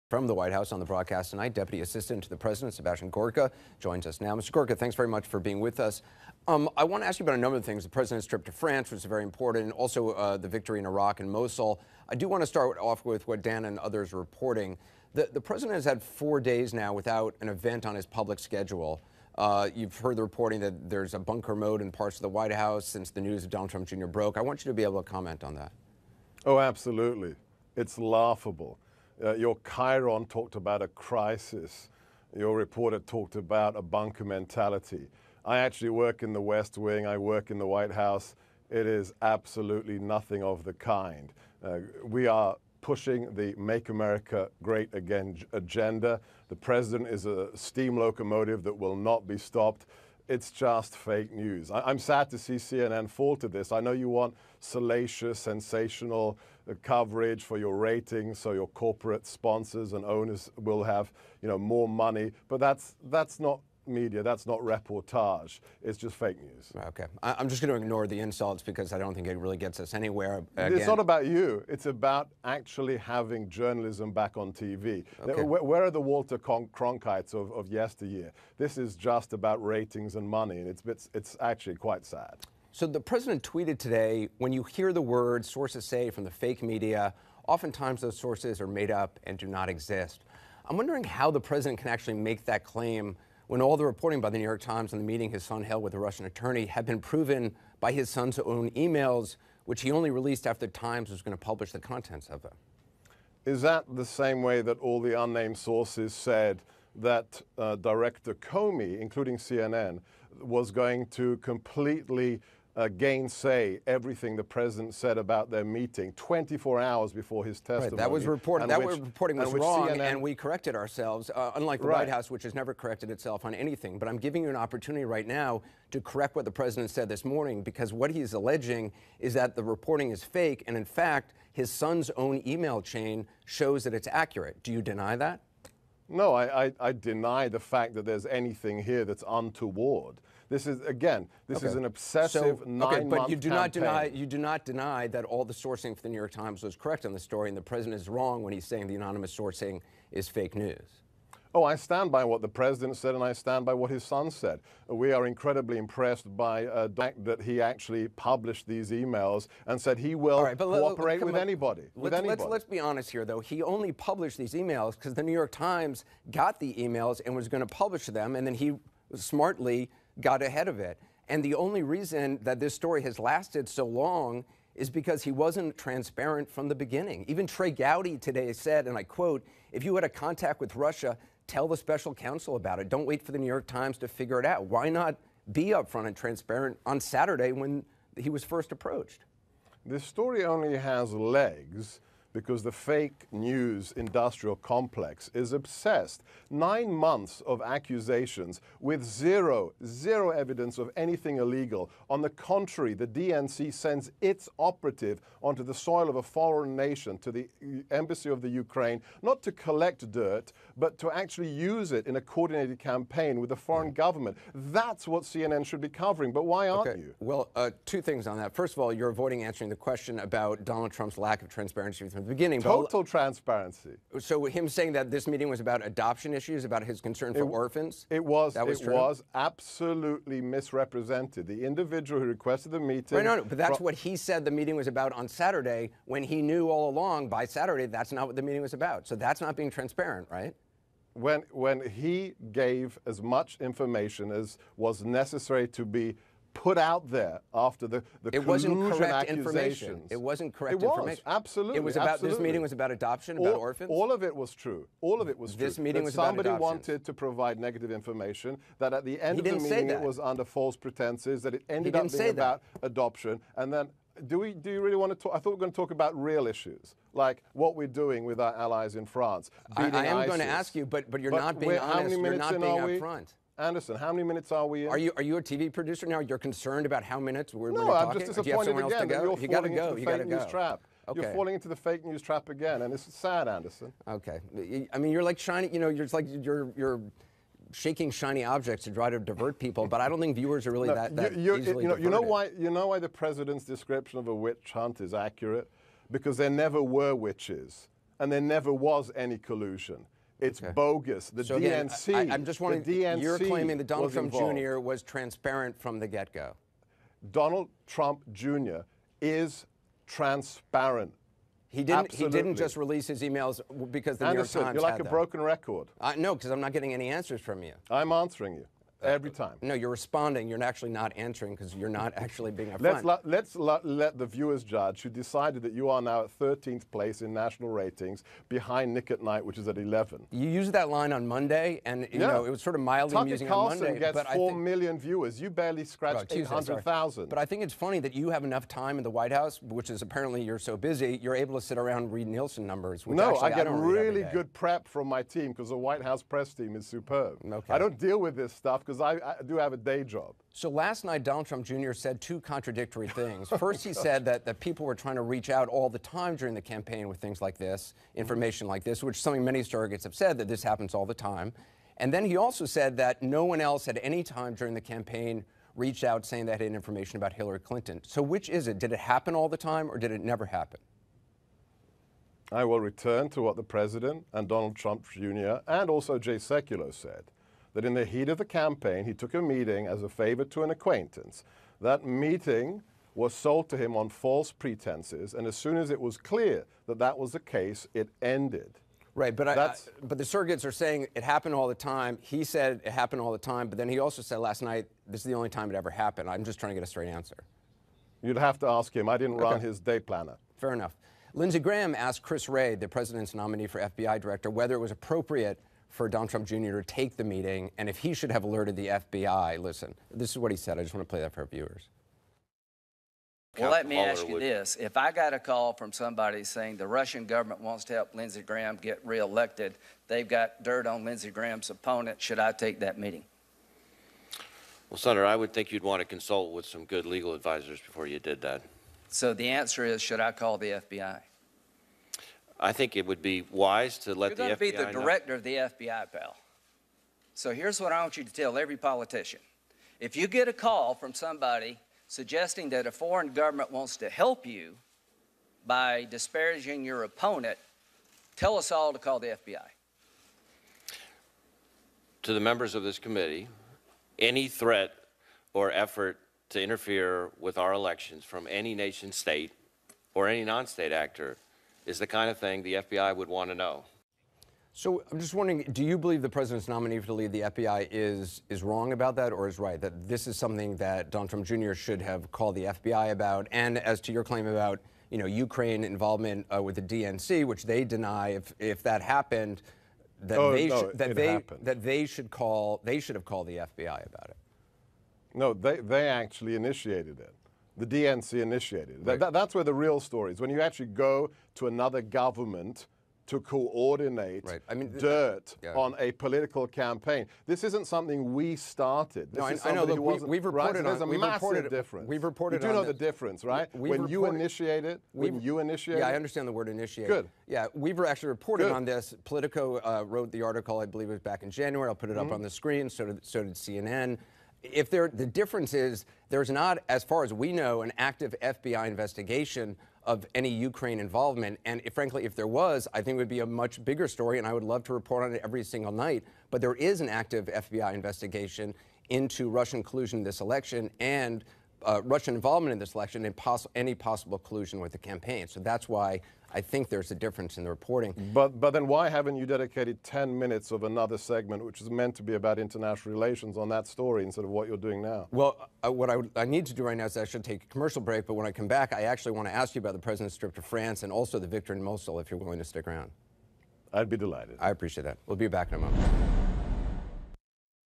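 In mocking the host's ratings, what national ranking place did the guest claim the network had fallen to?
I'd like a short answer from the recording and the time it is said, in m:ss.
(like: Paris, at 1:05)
13th, at 5:26.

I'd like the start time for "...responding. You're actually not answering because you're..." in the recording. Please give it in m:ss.
5:19.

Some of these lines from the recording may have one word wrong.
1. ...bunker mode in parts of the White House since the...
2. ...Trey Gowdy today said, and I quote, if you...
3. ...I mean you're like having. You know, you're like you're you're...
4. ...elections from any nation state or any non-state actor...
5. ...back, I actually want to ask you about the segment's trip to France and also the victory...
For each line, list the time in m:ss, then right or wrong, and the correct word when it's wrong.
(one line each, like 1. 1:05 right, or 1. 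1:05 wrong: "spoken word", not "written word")
1. 0:21 right
2. 2:57 right
3. 4:44 wrong: "shining", not "having"
4. 7:37 right
5. 9:08 wrong: "president", not "segment".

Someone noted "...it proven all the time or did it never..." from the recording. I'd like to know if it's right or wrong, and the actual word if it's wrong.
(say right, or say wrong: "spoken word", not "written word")
wrong: "happen", not "proven".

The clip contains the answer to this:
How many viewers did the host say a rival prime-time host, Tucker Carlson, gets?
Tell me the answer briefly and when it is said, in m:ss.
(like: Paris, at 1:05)
800,000, at 5:36.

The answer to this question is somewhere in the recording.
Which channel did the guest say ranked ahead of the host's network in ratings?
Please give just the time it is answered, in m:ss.
5:28.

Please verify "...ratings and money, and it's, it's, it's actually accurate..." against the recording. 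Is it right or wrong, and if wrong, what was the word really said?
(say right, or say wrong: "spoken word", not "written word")
wrong: "quite", not "accurate".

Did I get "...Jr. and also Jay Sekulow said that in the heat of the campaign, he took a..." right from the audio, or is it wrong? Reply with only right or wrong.
right.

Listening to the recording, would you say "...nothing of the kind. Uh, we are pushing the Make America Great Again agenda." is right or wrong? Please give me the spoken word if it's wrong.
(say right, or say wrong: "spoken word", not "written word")
right.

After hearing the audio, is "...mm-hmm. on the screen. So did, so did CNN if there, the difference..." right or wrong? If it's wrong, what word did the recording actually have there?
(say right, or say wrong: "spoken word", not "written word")
right.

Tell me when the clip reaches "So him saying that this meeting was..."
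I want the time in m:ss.
3:44.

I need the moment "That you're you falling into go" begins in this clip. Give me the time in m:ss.
4:39.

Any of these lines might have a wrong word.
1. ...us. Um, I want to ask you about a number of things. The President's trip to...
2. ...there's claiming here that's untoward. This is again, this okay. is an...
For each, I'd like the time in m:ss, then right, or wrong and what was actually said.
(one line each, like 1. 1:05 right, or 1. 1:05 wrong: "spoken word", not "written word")
1. 0:05 right
2. 2:18 wrong: "anything", not "claiming".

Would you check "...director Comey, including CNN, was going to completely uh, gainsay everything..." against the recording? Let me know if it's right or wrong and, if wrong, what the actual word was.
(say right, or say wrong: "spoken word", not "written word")
right.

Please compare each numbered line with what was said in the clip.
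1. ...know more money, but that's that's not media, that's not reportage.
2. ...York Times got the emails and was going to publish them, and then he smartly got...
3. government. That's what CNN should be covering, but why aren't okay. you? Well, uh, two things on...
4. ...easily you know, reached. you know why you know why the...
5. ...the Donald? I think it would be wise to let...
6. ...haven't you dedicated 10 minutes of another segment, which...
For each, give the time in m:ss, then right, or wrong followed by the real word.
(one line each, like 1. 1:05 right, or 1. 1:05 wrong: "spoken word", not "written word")
1. 1:01 right
2. 2:45 right
3. 3:33 right
4. 4:51 wrong: "diverted", not "reached"
5. 7:10 wrong: "FBI", not "Donald"
6. 8:59 right.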